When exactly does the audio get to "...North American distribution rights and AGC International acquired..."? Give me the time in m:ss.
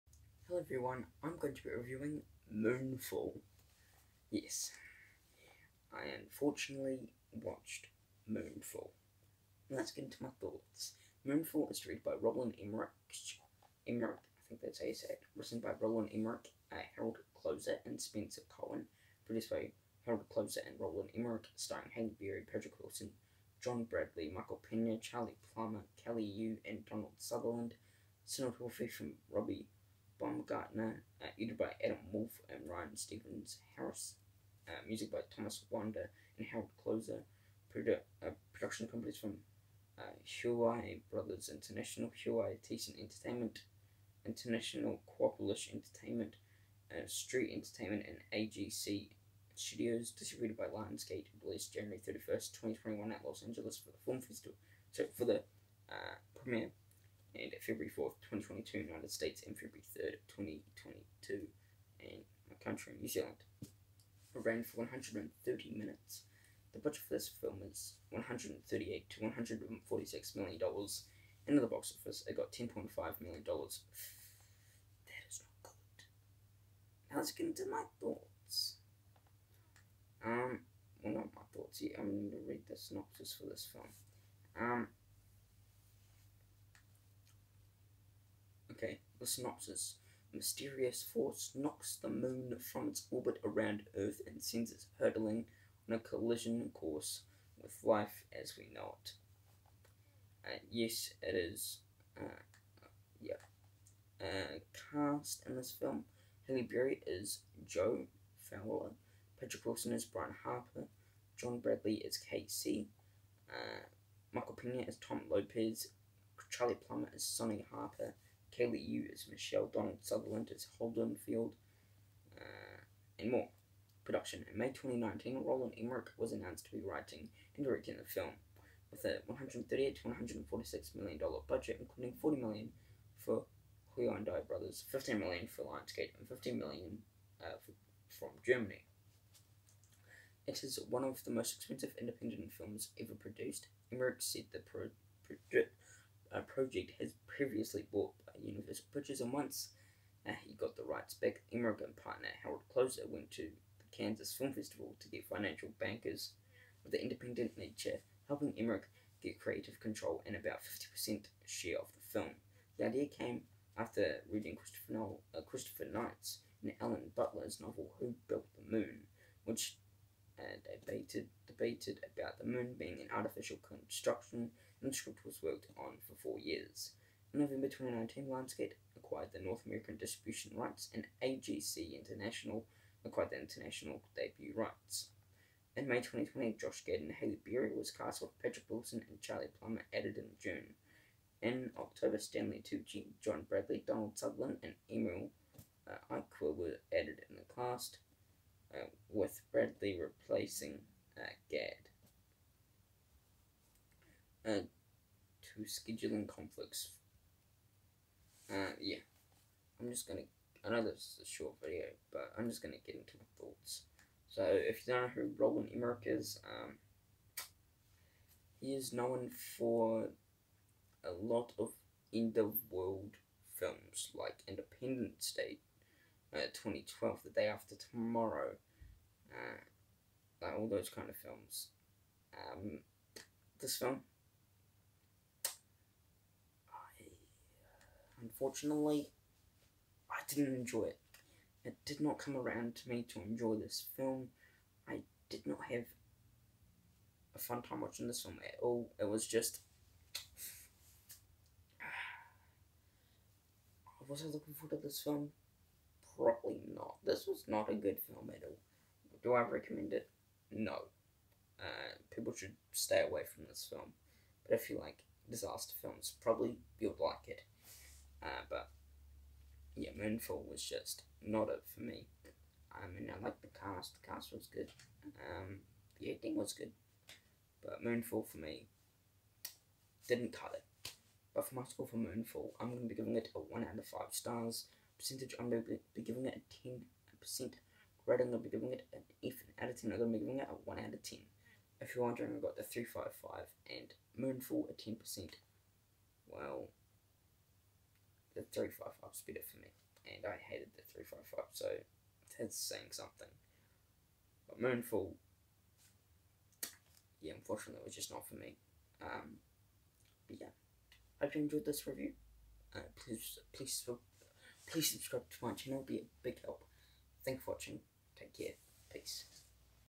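2:59.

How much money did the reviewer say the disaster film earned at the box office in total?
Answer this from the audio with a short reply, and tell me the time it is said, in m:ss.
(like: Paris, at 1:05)
$10.5 million, at 1:12.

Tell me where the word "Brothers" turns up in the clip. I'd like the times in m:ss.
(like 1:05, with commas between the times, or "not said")
0:41, 2:14.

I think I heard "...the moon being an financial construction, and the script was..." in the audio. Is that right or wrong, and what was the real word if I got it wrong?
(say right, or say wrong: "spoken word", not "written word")
wrong: "artificial", not "financial".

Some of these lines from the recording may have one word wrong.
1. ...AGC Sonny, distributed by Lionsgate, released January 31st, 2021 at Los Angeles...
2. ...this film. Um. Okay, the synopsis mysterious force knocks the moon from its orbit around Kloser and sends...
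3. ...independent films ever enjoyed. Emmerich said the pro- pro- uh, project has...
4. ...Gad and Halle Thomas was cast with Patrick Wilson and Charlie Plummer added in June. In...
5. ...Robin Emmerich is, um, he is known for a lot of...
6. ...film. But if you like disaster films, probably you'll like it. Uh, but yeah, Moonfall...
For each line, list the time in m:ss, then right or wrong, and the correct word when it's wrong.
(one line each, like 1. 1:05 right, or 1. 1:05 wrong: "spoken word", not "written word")
1. 0:48 wrong: "Studios", not "Sonny"
2. 1:23 wrong: "Earth", not "Kloser"
3. 2:22 wrong: "produced", not "enjoyed"
4. 3:06 wrong: "Berry", not "Thomas"
5. 3:35 right
6. 4:23 right.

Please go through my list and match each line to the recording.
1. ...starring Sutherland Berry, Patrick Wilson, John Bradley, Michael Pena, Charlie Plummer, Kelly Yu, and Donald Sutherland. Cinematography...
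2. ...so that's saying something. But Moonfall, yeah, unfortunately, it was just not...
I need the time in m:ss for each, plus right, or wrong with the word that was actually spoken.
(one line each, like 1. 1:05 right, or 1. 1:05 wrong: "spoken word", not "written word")
1. 0:21 wrong: "Hank", not "Sutherland"
2. 5:01 right.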